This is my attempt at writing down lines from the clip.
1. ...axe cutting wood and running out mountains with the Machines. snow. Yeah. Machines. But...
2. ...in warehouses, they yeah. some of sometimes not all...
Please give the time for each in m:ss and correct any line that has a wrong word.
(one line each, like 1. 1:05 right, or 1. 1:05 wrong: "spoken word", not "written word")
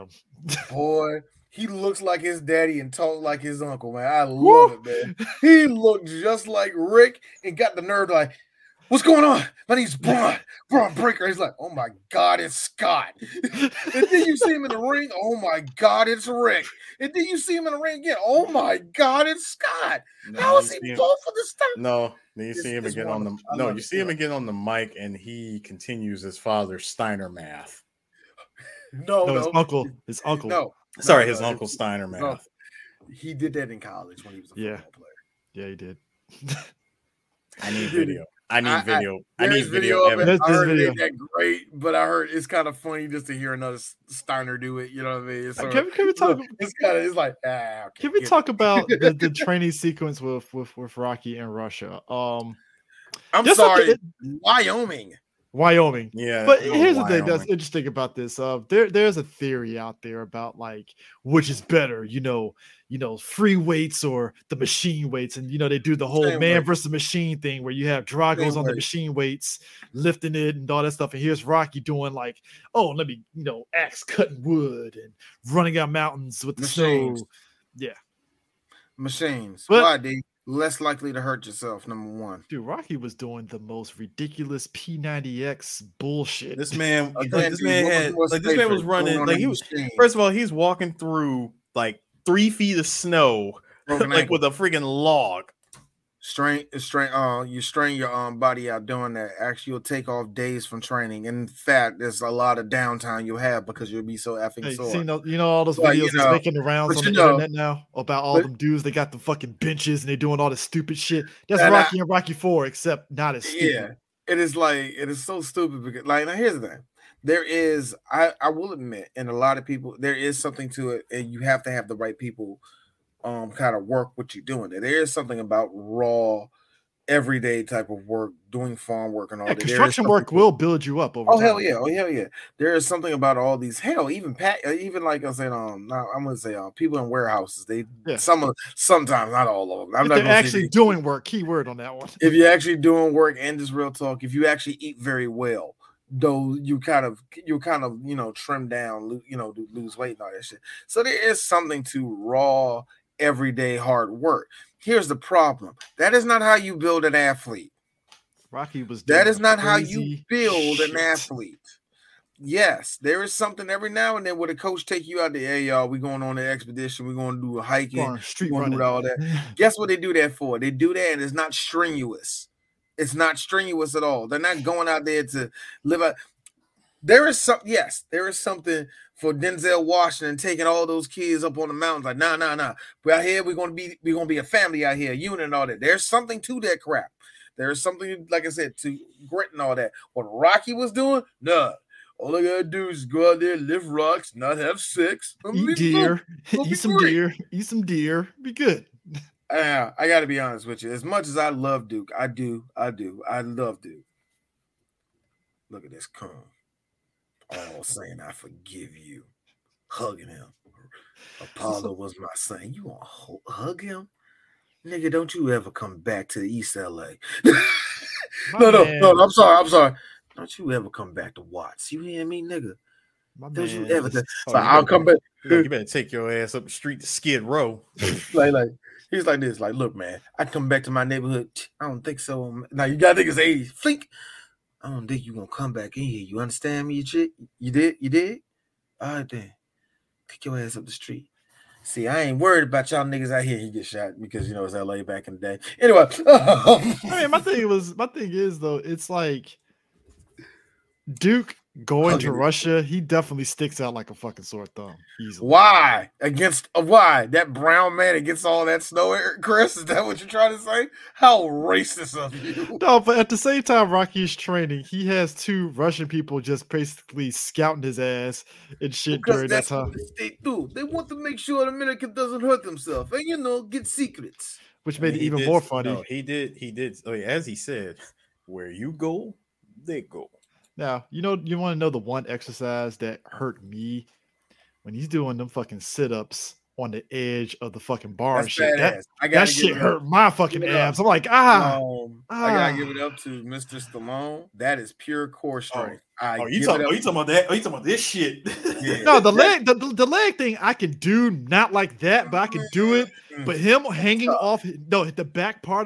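1. 1:13 right
2. 2:16 right.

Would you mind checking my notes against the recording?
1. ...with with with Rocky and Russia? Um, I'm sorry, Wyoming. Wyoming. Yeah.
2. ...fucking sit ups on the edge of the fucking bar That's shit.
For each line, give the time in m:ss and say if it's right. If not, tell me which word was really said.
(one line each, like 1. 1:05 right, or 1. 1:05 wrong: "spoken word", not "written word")
1. 0:50 right
2. 4:45 right.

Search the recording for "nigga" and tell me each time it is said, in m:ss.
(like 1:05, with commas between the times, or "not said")
3:34, 3:42, 4:03.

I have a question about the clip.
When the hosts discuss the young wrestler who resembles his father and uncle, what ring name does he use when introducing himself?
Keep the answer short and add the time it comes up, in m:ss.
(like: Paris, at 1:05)
Bron Breakker, at 0:10.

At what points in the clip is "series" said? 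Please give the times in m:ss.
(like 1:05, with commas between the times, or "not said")
not said.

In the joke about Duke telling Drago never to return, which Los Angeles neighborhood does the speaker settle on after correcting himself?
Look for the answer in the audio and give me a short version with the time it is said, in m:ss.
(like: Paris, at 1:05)
Watts, at 3:41.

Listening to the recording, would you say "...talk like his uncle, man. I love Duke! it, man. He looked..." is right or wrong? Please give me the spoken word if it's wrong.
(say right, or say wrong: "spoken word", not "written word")
wrong: "Woo", not "Duke".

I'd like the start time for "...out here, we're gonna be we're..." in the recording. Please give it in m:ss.
3:03.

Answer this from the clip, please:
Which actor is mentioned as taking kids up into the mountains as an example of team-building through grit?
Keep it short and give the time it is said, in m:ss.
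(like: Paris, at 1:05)
Denzel Washington, at 2:59.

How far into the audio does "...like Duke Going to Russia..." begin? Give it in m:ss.
4:09.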